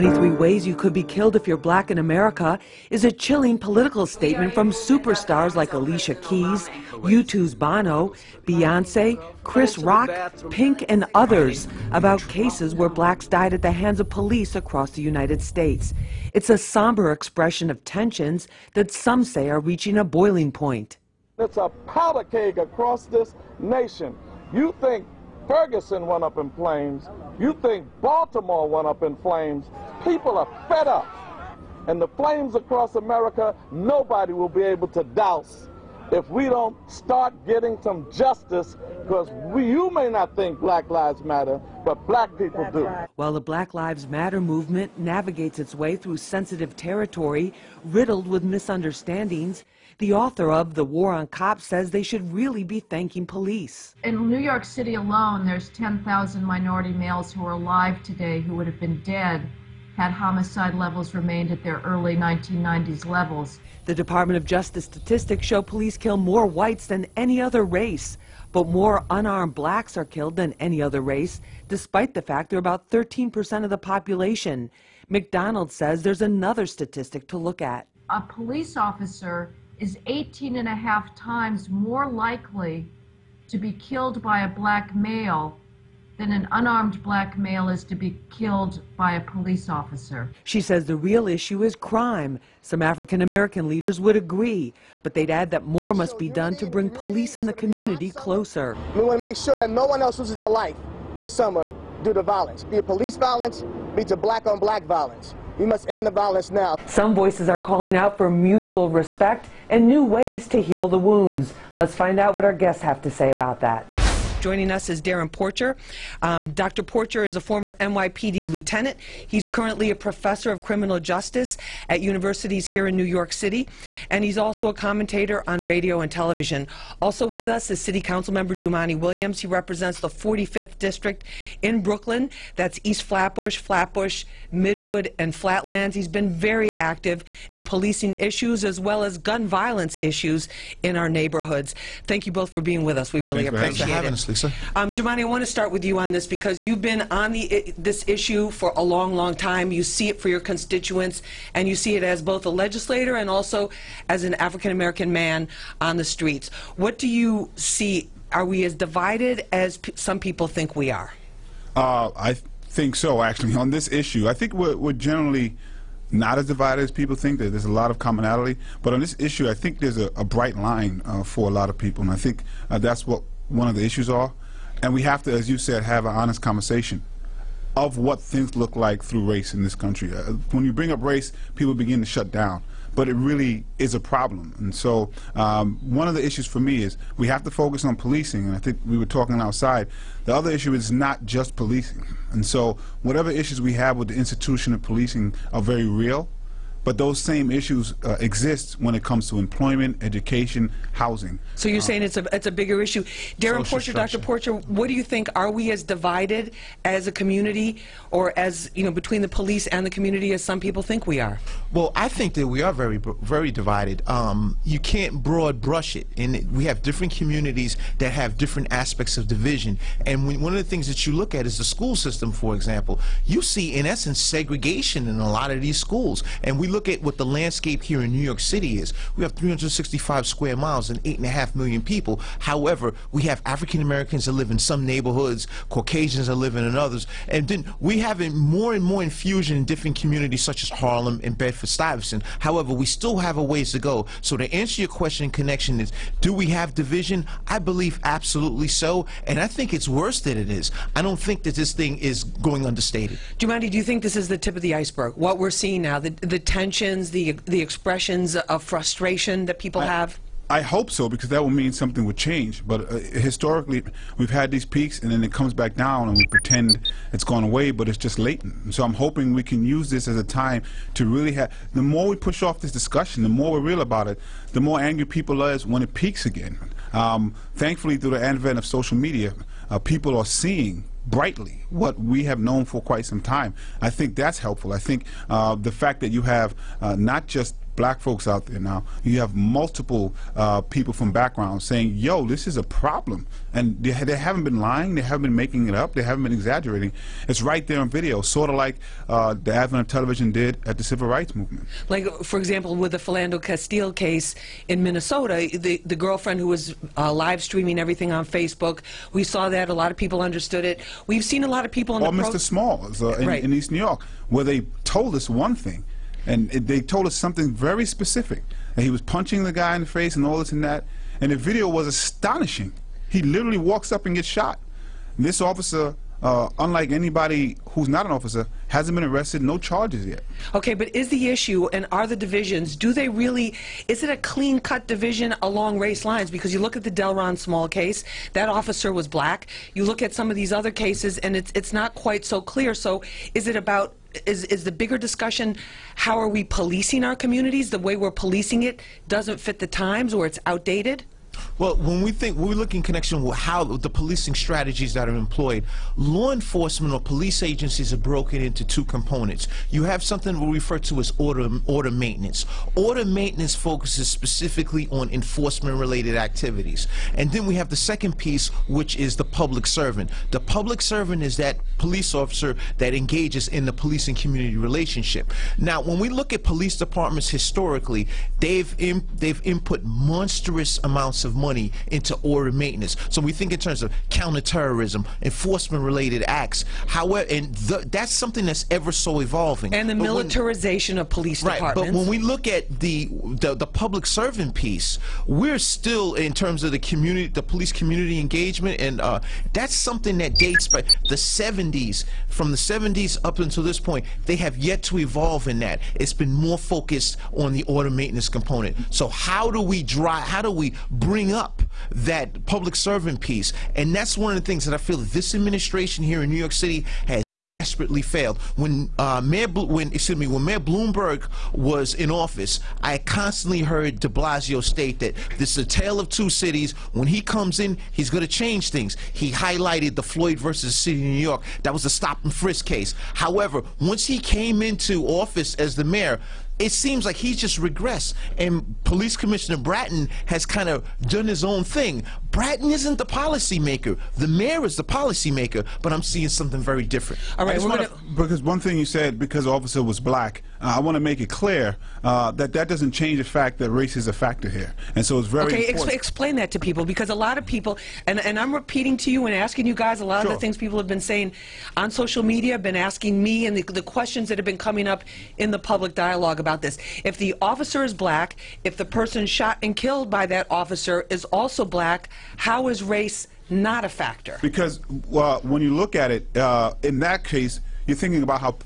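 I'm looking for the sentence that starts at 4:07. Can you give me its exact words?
I believe absolutely so, and I think it's worse than it is.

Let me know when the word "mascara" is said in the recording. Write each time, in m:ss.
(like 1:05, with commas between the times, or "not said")
not said.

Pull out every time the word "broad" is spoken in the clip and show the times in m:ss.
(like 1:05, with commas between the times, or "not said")
3:35.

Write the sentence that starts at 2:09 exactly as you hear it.
He represents the 45th District in Brooklyn.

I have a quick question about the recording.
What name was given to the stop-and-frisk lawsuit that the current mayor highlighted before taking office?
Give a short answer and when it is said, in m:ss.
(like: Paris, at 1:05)
Floyd versus the City of New York, at 7:10.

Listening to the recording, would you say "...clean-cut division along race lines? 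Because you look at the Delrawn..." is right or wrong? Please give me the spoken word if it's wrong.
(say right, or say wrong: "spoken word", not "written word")
right.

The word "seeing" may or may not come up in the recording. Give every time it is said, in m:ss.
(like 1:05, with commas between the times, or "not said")
4:15, 4:40, 7:26.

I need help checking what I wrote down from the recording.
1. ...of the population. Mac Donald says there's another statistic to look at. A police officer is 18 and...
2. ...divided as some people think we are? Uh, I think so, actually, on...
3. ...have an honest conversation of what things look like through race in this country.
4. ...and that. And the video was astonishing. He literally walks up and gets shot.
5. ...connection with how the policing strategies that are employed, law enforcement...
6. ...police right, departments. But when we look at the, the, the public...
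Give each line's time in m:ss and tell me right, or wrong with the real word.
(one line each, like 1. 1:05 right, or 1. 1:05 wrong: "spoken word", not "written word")
1. 1:13 right
2. 2:38 right
3. 2:55 right
4. 5:20 right
5. 5:52 right
6. 6:31 right.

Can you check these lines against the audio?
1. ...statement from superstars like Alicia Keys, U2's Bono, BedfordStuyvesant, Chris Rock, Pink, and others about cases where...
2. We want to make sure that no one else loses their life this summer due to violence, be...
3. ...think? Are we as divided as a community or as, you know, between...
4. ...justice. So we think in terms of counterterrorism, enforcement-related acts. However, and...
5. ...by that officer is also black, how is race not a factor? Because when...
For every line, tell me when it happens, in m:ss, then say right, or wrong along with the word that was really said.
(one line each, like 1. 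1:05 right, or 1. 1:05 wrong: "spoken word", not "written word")
1. 0:04 wrong: "Beyonce", not "BedfordStuyvesant"
2. 1:38 right
3. 3:25 right
4. 6:22 wrong: "maintenance", not "justice"
5. 7:50 right.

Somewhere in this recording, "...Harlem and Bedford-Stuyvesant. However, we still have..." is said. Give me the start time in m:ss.
4:00.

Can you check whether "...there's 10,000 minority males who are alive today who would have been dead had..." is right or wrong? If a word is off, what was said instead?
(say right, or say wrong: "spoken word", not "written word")
right.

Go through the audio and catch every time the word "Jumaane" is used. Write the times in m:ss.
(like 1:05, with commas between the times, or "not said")
2:08, 4:13.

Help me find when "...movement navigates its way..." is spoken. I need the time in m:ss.
0:44.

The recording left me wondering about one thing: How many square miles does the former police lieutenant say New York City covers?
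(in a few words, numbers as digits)
365.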